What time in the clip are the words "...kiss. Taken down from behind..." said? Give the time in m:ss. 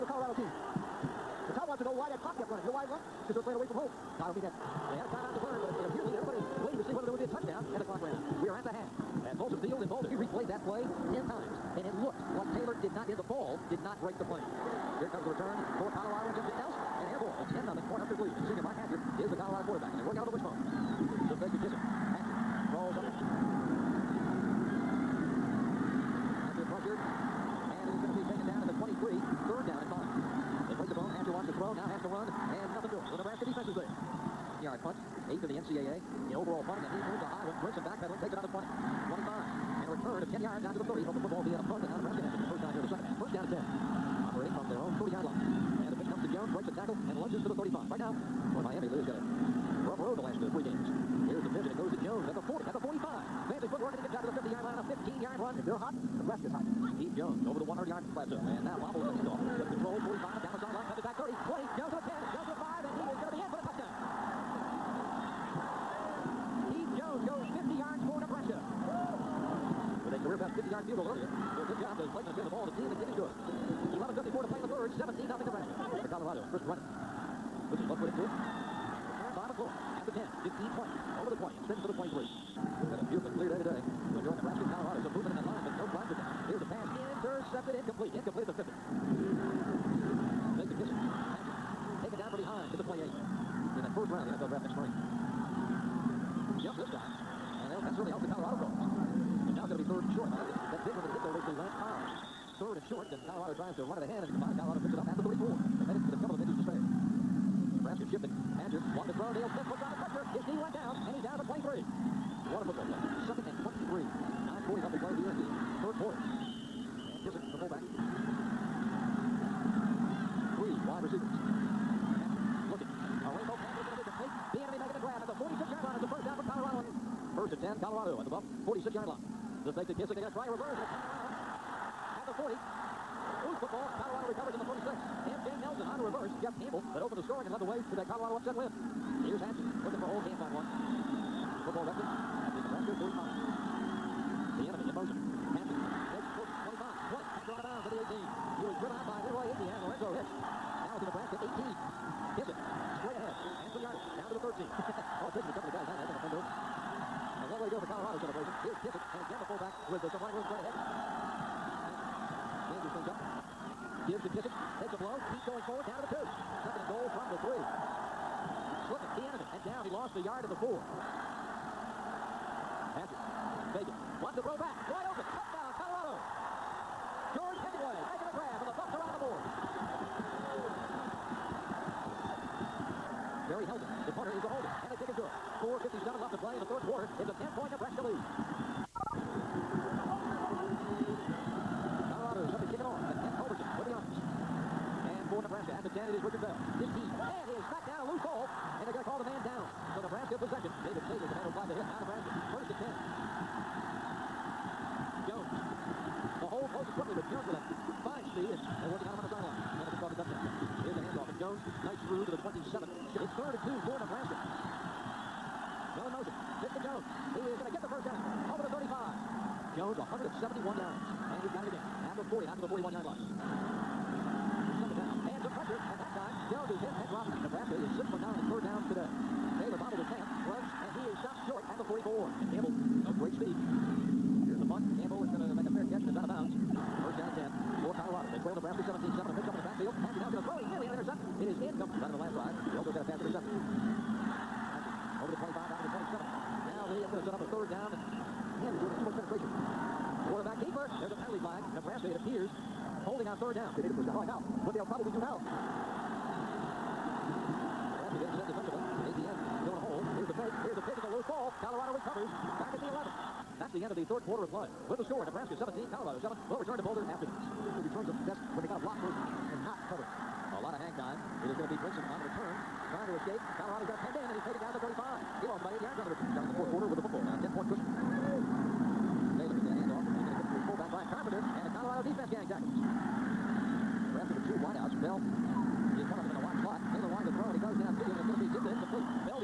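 1:30.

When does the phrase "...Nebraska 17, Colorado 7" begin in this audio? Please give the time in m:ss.
4:25.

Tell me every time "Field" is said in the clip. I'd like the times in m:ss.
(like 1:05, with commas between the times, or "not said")
0:09.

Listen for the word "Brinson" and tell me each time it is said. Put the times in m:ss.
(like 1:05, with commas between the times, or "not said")
0:37, 4:31.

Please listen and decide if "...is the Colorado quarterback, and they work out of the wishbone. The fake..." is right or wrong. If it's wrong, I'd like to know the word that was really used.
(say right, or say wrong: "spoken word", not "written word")
right.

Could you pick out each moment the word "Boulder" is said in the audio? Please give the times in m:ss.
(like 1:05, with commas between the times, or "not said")
0:09, 4:26.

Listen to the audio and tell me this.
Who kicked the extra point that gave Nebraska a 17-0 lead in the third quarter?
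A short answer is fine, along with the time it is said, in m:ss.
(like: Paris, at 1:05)
Blakeman, at 1:12.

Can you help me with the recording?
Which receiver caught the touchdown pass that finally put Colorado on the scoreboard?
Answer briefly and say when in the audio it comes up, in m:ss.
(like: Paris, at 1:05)
George Hemingway, at 2:57.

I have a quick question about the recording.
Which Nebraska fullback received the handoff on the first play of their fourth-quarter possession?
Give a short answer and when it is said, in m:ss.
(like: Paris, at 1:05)
Brian Carpenter, at 4:40.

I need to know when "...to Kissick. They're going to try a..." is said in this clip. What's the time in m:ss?
2:09.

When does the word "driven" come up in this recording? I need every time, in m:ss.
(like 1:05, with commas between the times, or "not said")
2:28.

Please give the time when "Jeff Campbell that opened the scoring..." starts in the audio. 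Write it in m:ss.
2:16.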